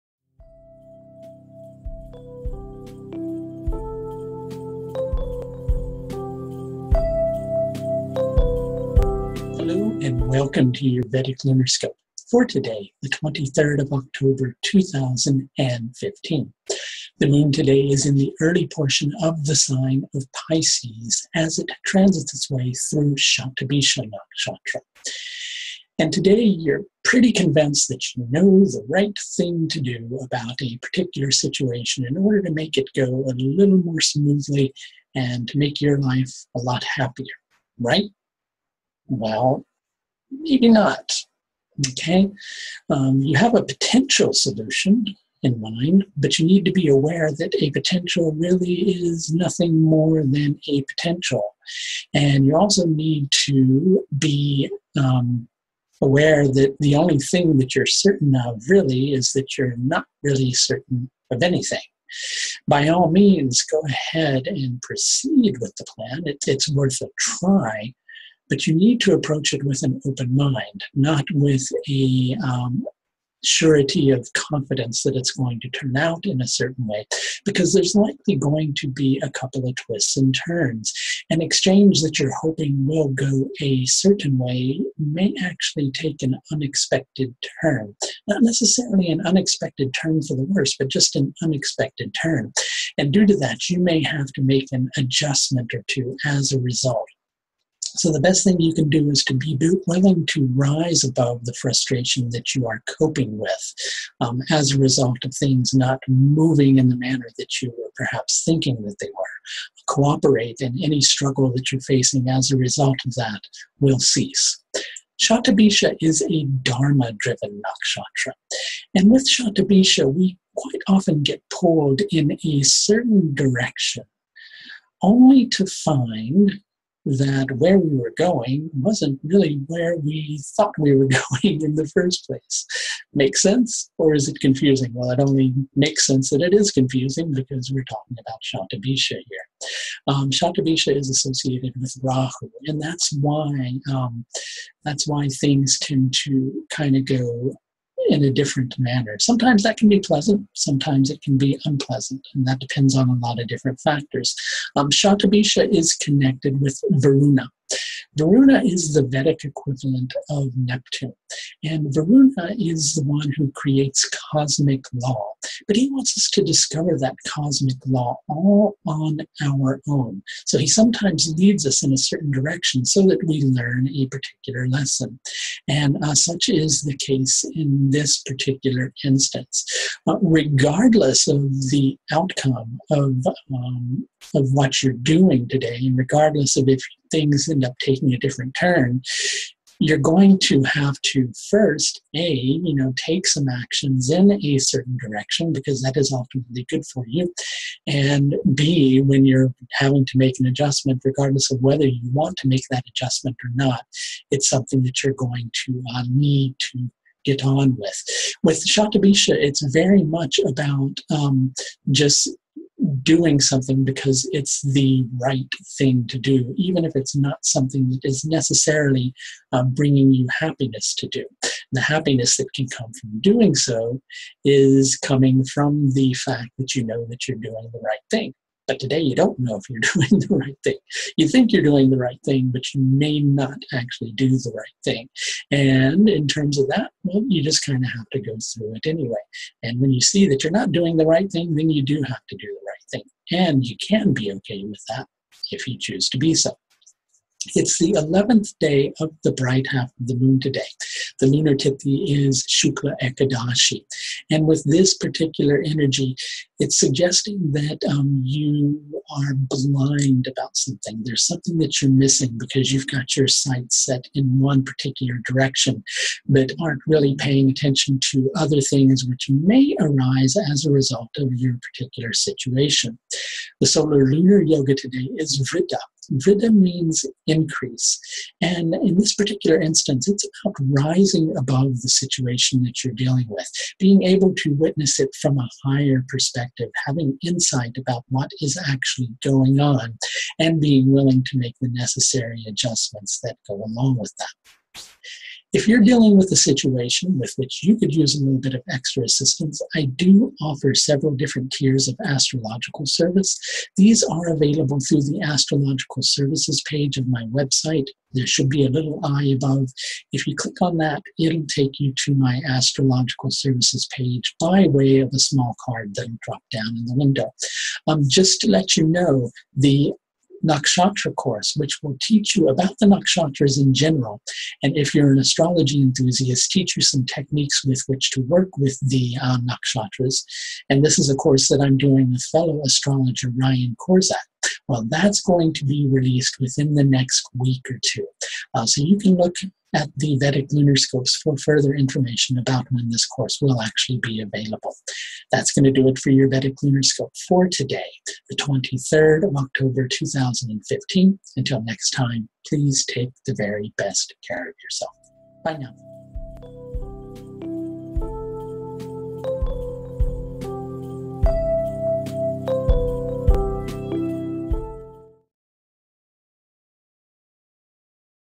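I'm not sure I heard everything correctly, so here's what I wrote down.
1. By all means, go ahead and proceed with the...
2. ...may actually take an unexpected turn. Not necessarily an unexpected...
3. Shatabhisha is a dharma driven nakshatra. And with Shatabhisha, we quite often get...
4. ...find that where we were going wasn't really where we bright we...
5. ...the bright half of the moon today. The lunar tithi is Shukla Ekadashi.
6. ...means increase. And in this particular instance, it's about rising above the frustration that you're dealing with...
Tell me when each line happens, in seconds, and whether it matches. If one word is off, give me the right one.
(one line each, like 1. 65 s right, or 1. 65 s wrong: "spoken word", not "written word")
1. 62 s right
2. 84 s right
3. 115 s right
4. 125 s wrong: "thought", not "bright"
5. 249 s right
6. 276 s wrong: "situation", not "frustration".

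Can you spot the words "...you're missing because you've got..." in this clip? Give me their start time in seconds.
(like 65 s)
261 s.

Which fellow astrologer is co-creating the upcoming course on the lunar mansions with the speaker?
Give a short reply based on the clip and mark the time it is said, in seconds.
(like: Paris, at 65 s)
Ryan Kurczak, at 333 s.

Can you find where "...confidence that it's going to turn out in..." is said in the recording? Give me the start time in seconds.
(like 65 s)
74 s.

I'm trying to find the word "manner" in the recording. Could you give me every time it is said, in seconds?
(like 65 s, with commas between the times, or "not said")
106 s, 148 s.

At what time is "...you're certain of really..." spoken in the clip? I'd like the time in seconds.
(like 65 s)
57 s.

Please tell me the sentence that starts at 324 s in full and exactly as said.
And if you're an astrology enthusiast, teach you some techniques with which to work with the uh, nakshatras.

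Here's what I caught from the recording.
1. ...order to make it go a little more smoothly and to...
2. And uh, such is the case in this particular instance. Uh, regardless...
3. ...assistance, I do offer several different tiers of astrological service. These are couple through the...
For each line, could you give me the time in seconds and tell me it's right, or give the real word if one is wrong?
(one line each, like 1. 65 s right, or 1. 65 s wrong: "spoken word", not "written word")
1. 32 s right
2. 175 s right
3. 299 s wrong: "available", not "couple".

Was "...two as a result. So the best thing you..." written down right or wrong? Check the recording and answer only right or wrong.
right.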